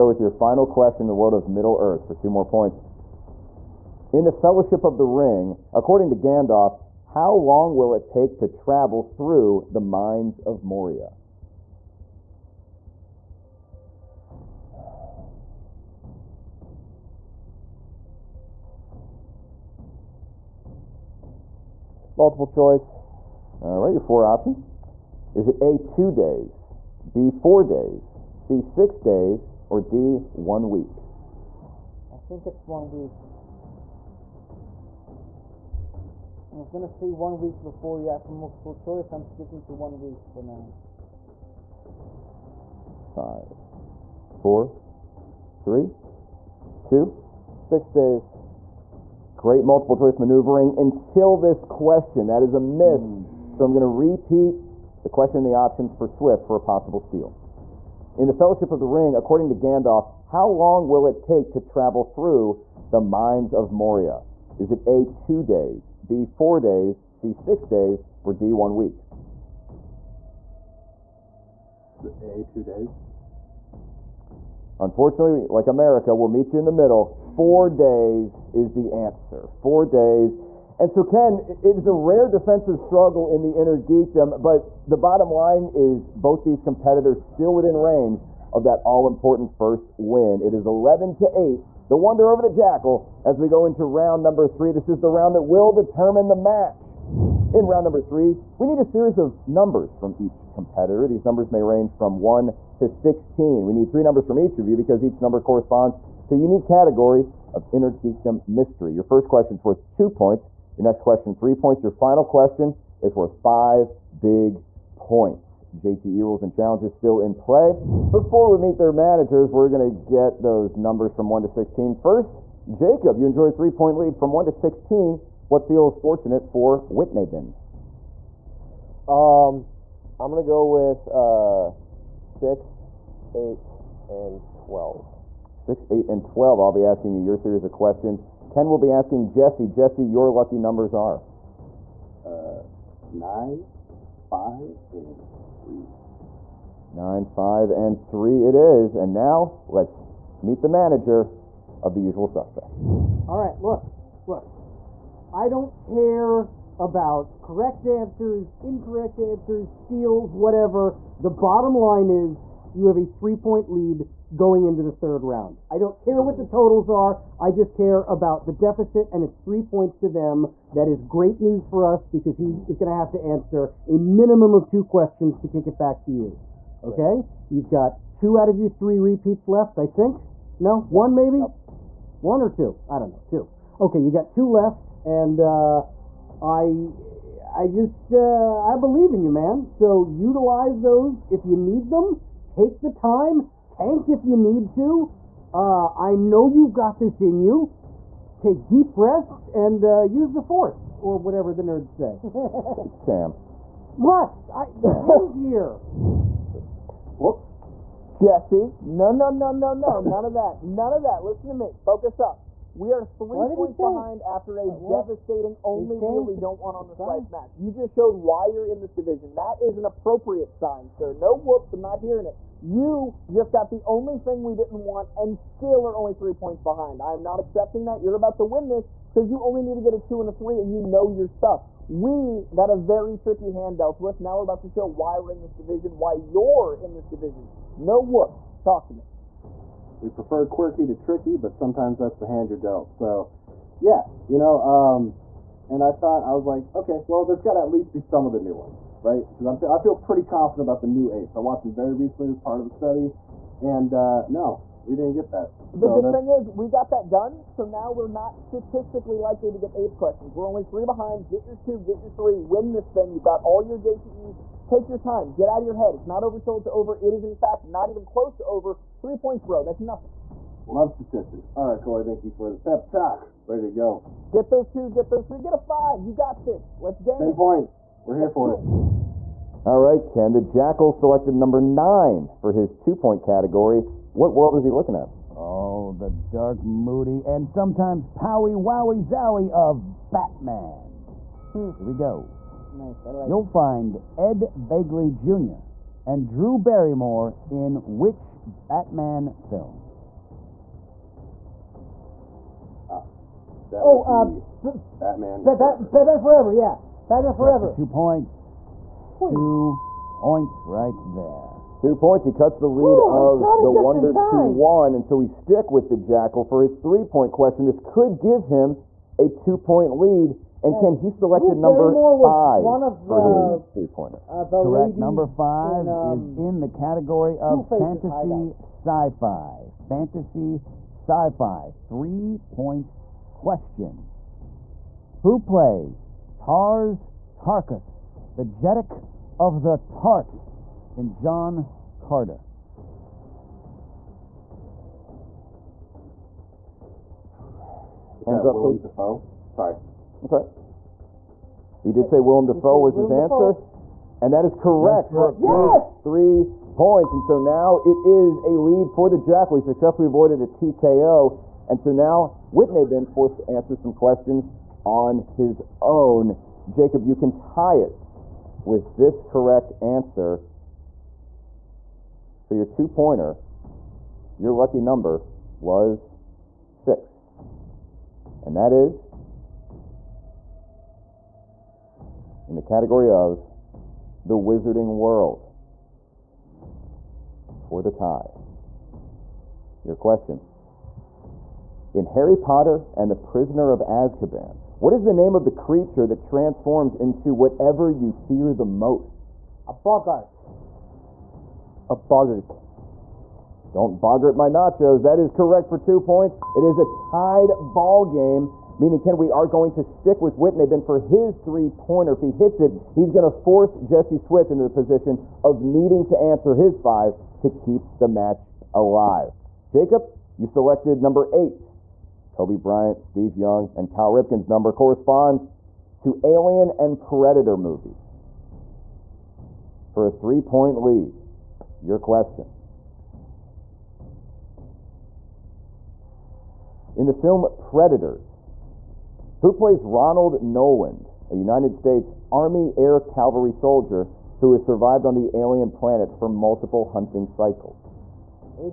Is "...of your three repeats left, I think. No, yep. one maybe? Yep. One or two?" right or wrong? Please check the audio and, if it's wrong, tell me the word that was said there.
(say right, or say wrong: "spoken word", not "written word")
right.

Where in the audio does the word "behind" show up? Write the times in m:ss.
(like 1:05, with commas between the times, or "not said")
3:33, 3:46, 4:20.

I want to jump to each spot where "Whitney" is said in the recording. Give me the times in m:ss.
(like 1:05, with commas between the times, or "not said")
6:02, 6:50.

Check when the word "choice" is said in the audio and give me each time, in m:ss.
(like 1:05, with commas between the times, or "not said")
0:22, 0:38, 0:49.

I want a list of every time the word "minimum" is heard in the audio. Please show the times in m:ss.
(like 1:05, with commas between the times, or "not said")
2:53.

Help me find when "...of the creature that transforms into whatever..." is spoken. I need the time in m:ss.
6:35.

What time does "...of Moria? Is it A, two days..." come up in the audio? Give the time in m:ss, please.
1:03.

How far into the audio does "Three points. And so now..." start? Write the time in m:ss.
5:56.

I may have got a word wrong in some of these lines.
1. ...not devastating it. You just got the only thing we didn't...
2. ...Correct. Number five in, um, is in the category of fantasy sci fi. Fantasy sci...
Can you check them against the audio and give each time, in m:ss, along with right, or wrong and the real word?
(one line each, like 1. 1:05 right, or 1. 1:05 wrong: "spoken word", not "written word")
1. 3:41 wrong: "hearing", not "devastating"
2. 5:24 right.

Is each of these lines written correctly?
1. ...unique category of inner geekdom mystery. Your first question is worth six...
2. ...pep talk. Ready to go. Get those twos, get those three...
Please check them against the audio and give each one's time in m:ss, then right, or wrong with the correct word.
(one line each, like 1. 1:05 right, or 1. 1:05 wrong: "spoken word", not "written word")
1. 1:46 wrong: "two", not "six"
2. 4:32 right.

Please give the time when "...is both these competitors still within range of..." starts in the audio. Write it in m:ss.
1:25.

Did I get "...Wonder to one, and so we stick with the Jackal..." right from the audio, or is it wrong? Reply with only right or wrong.
right.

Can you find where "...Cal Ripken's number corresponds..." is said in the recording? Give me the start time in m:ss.
7:03.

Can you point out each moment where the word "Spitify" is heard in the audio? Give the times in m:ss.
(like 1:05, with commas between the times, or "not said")
not said.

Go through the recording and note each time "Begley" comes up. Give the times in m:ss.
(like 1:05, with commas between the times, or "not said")
4:54.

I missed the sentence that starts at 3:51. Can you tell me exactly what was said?
We got a very tricky hand dealt to us.